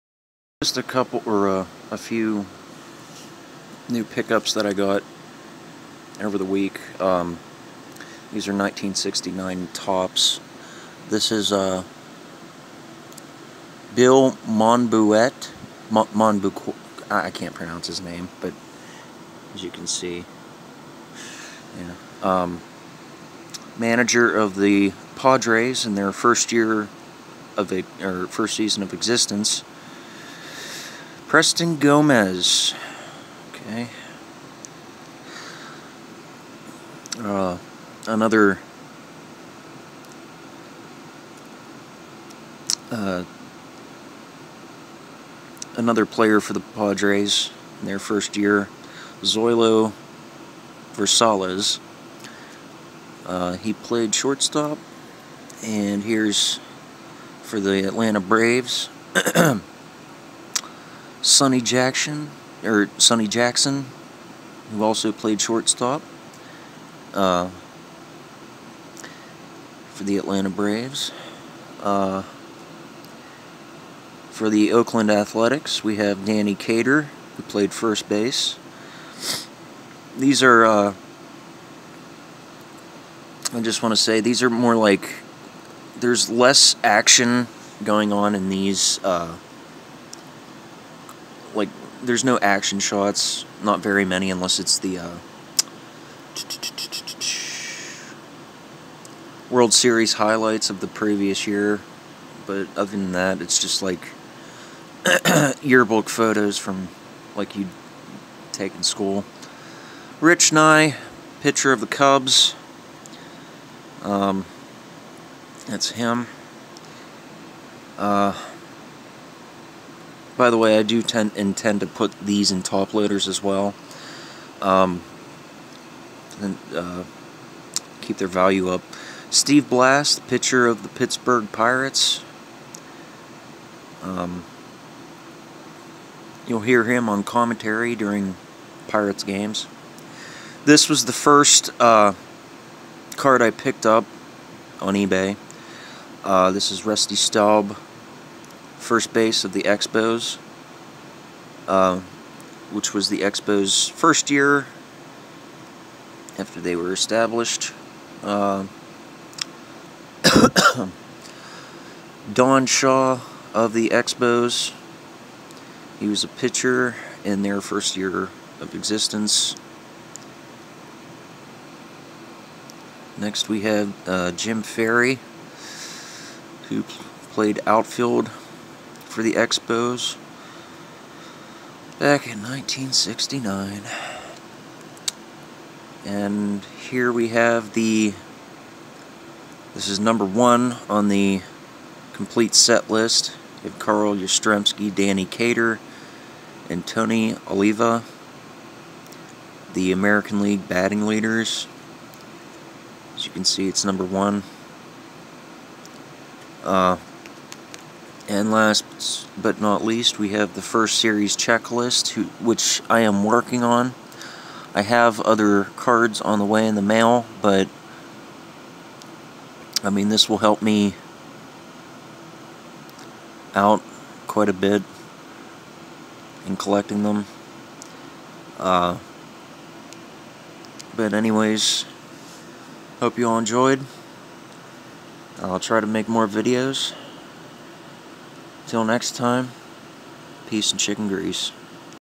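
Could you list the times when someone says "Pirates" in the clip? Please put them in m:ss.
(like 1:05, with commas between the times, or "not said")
2:11, 2:18.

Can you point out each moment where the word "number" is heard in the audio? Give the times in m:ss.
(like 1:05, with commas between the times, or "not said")
3:09, 3:23.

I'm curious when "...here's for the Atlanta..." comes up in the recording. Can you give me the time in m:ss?
0:56.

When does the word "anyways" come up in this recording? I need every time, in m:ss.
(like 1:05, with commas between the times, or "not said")
3:51.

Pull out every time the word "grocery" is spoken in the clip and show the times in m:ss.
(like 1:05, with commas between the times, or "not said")
not said.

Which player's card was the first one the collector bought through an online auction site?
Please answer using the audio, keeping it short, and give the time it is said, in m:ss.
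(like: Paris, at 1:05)
Rusty Staub, at 2:26.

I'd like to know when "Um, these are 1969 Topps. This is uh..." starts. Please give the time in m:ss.
0:07.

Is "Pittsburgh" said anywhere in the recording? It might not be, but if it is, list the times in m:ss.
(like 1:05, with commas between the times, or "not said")
2:10.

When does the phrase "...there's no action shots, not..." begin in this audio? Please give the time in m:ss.
1:32.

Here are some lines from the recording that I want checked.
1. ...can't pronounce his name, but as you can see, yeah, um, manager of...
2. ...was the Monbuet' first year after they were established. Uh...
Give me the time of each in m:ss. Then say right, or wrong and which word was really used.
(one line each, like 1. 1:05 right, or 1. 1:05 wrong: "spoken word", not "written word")
1. 0:17 right
2. 2:32 wrong: "Expos", not "Monbuet".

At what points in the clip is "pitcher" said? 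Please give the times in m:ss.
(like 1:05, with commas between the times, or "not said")
1:51, 2:10, 2:46.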